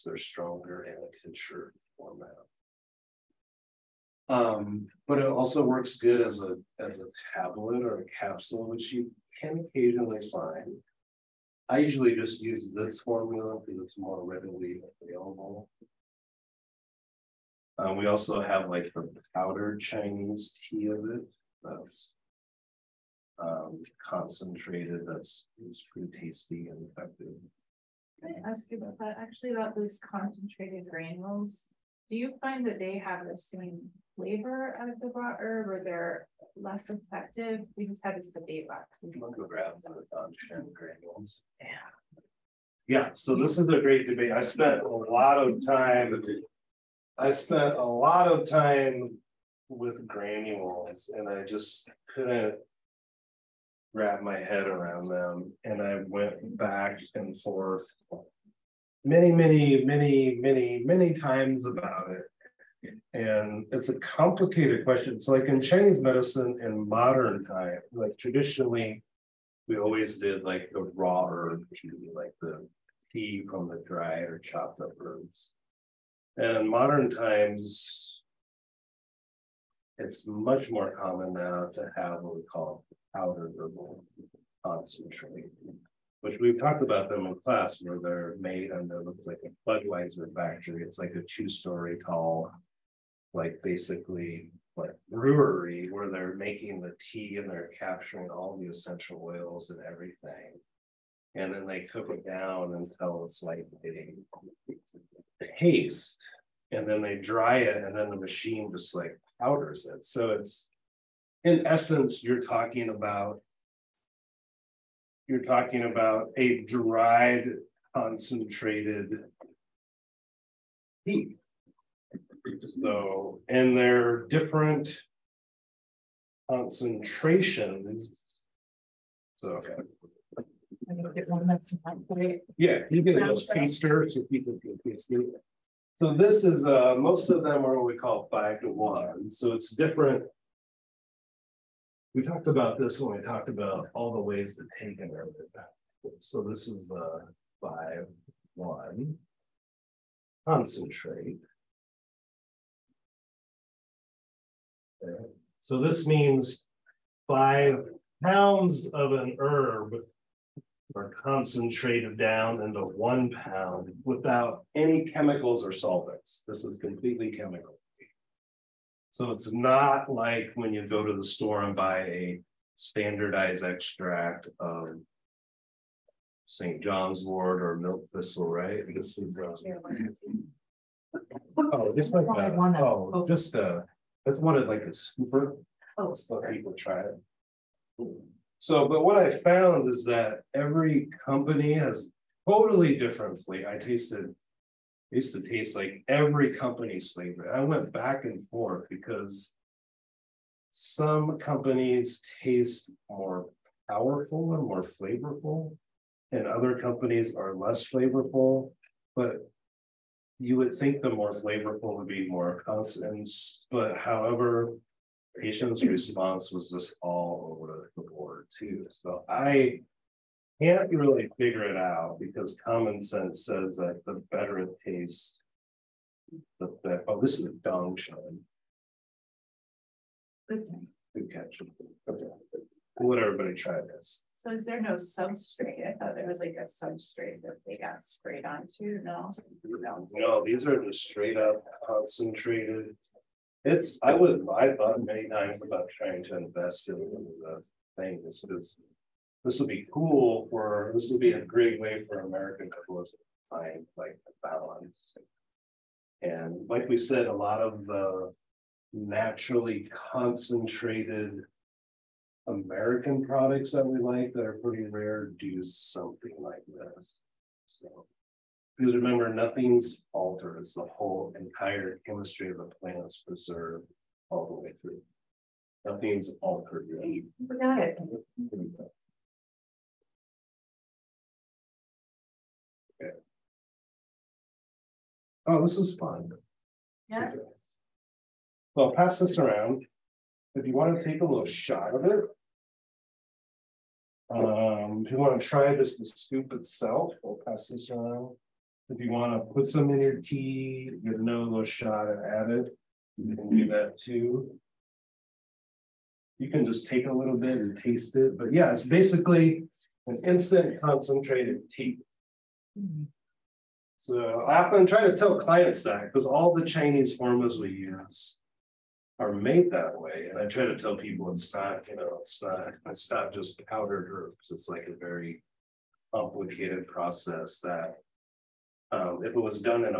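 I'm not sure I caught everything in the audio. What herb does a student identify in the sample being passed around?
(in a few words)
Dan Shen.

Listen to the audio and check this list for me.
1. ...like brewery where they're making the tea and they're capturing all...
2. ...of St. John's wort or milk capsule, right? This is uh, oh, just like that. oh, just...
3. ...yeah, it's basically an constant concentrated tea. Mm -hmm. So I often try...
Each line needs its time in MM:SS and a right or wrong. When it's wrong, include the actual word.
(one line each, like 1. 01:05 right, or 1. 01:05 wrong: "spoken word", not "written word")
1. 01:34 right
2. 02:54 wrong: "thistle", not "capsule"
3. 05:08 wrong: "instant", not "constant".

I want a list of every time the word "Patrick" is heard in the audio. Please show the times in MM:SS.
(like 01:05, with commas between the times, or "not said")
not said.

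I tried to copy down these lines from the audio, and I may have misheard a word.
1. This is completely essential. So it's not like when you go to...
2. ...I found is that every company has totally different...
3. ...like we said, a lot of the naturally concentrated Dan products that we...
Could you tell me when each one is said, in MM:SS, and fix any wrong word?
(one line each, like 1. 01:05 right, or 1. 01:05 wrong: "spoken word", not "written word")
1. 02:46 wrong: "chemical", not "essential"
2. 03:09 right
3. 04:16 wrong: "American", not "Dan".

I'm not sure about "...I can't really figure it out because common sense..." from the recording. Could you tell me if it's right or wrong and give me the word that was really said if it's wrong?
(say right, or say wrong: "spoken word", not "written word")
right.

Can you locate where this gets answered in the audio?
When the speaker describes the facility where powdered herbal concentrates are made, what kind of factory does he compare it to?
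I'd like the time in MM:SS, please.
01:29.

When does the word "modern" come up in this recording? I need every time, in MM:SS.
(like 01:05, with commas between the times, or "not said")
01:06, 01:16.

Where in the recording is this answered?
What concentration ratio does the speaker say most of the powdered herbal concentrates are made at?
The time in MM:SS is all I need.
02:18.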